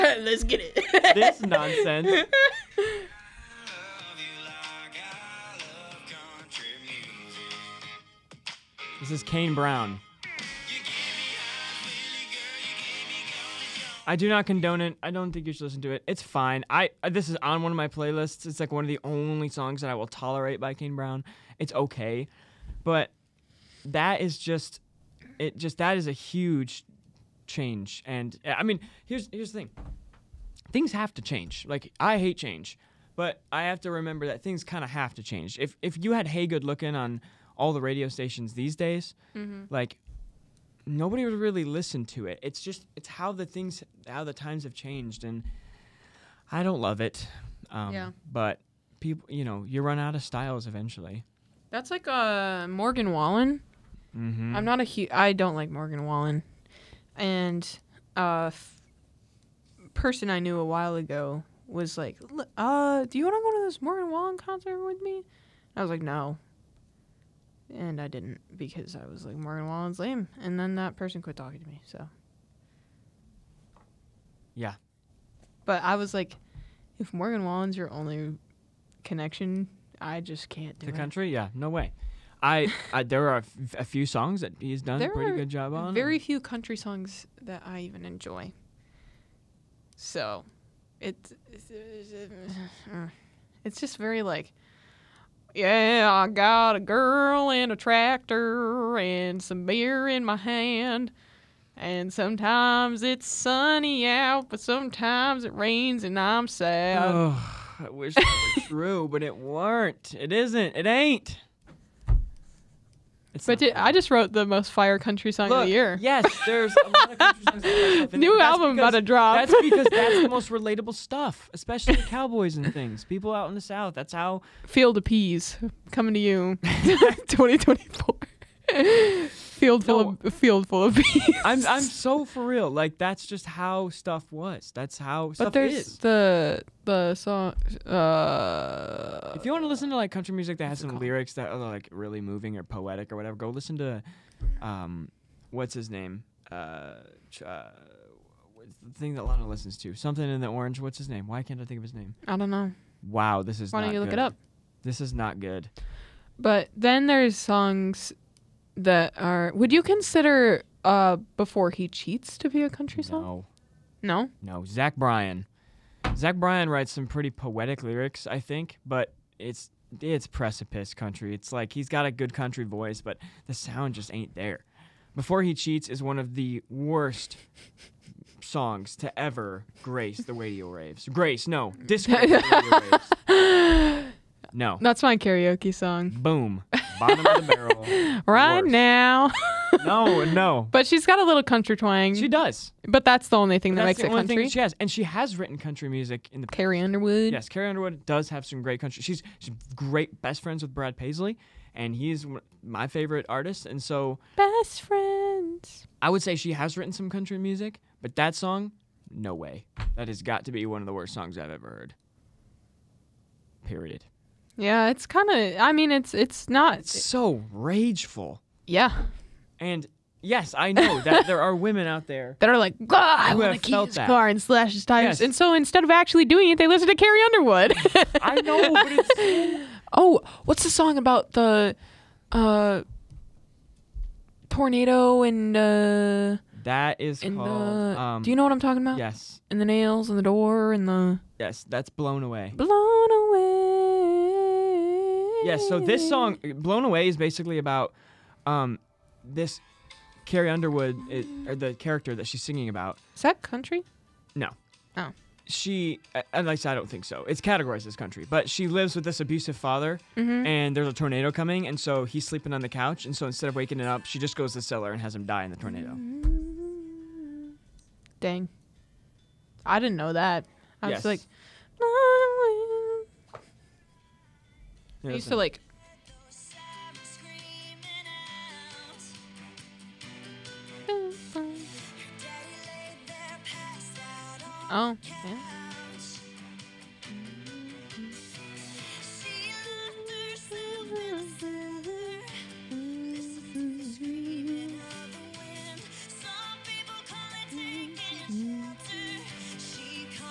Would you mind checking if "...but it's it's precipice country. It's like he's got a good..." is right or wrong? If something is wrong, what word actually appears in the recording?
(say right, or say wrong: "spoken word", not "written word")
right.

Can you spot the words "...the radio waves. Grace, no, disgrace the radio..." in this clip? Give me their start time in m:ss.
3:00.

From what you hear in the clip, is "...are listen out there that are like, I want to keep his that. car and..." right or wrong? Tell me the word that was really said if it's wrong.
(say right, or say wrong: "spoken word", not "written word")
wrong: "women", not "listen".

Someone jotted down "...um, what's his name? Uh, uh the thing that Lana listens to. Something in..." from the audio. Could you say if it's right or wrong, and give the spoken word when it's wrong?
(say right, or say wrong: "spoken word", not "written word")
right.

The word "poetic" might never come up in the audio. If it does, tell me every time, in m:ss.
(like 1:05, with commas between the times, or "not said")
2:22, 2:47.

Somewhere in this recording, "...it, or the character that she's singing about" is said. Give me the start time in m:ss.
4:11.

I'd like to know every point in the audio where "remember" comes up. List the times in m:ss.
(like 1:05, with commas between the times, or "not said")
0:33.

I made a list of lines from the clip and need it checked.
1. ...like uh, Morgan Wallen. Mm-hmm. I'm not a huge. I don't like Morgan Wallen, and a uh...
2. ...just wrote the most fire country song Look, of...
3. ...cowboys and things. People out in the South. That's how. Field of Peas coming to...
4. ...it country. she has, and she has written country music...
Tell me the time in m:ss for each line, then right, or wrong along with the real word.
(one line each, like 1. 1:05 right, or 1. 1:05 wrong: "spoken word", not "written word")
1. 0:51 right
2. 1:53 right
3. 2:01 right
4. 3:13 right.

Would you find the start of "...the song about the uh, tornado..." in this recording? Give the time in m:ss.
3:50.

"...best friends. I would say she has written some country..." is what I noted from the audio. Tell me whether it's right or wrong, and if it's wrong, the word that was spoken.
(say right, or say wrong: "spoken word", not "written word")
right.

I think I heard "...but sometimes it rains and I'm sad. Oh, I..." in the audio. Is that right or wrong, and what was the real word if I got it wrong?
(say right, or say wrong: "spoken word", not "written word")
right.